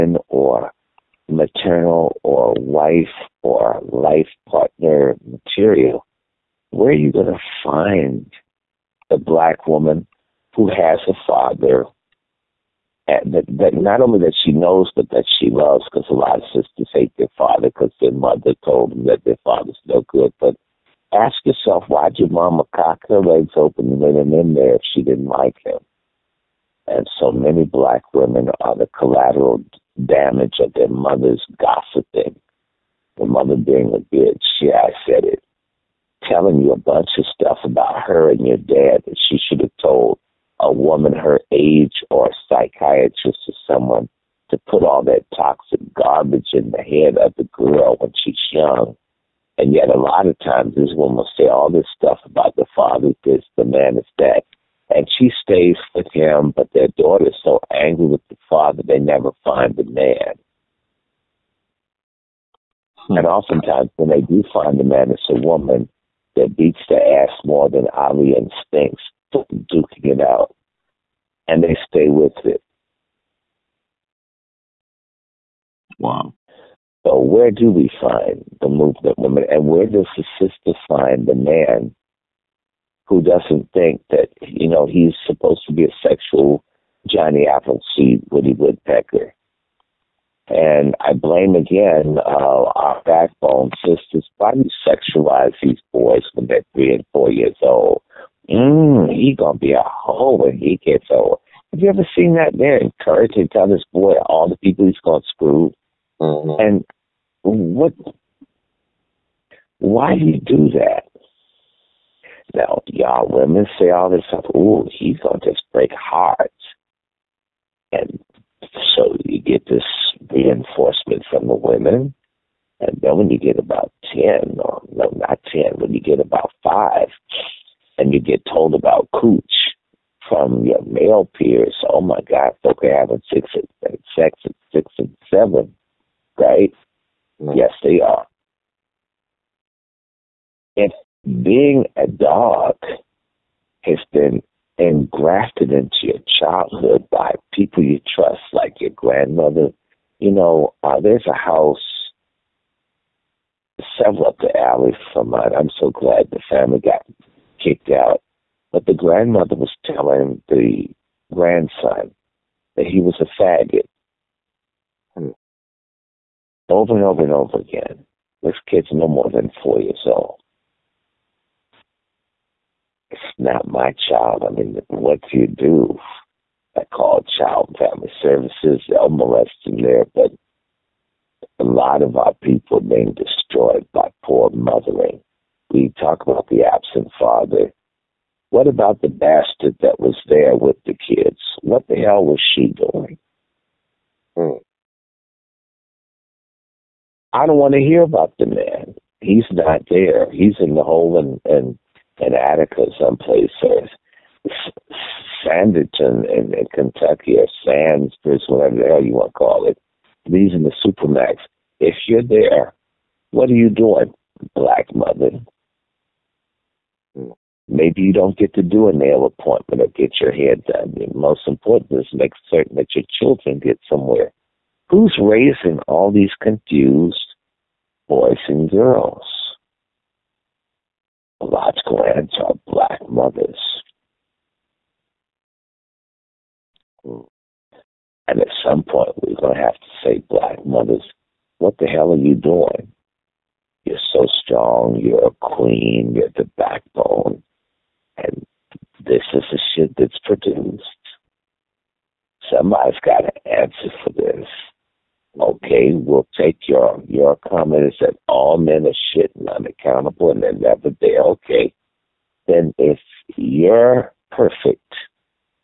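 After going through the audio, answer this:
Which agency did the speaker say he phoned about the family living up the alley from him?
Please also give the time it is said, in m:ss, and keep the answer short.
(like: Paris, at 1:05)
Child and Family Services, at 2:57.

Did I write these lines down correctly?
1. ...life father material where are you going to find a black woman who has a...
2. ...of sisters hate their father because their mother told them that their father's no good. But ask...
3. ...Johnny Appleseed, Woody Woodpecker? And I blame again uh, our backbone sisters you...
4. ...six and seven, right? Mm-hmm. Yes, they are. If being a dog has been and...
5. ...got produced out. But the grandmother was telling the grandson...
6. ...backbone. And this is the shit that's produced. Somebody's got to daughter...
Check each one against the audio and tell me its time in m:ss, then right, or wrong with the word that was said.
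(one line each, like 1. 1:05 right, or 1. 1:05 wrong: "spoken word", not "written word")
1. 0:03 wrong: "partner", not "father"
2. 0:16 right
3. 1:27 right
4. 2:14 right
5. 2:36 wrong: "kicked", not "produced"
6. 4:06 wrong: "answer", not "daughter".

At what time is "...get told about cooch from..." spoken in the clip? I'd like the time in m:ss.
2:08.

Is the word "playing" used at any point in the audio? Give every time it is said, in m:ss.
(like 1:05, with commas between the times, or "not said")
not said.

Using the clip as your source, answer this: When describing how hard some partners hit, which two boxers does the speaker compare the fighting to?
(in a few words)
Ali and Spinks.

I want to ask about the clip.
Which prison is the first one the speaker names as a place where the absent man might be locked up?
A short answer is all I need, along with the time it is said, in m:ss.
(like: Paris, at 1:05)
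Attica, at 3:22.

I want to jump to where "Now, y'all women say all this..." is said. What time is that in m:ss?
1:52.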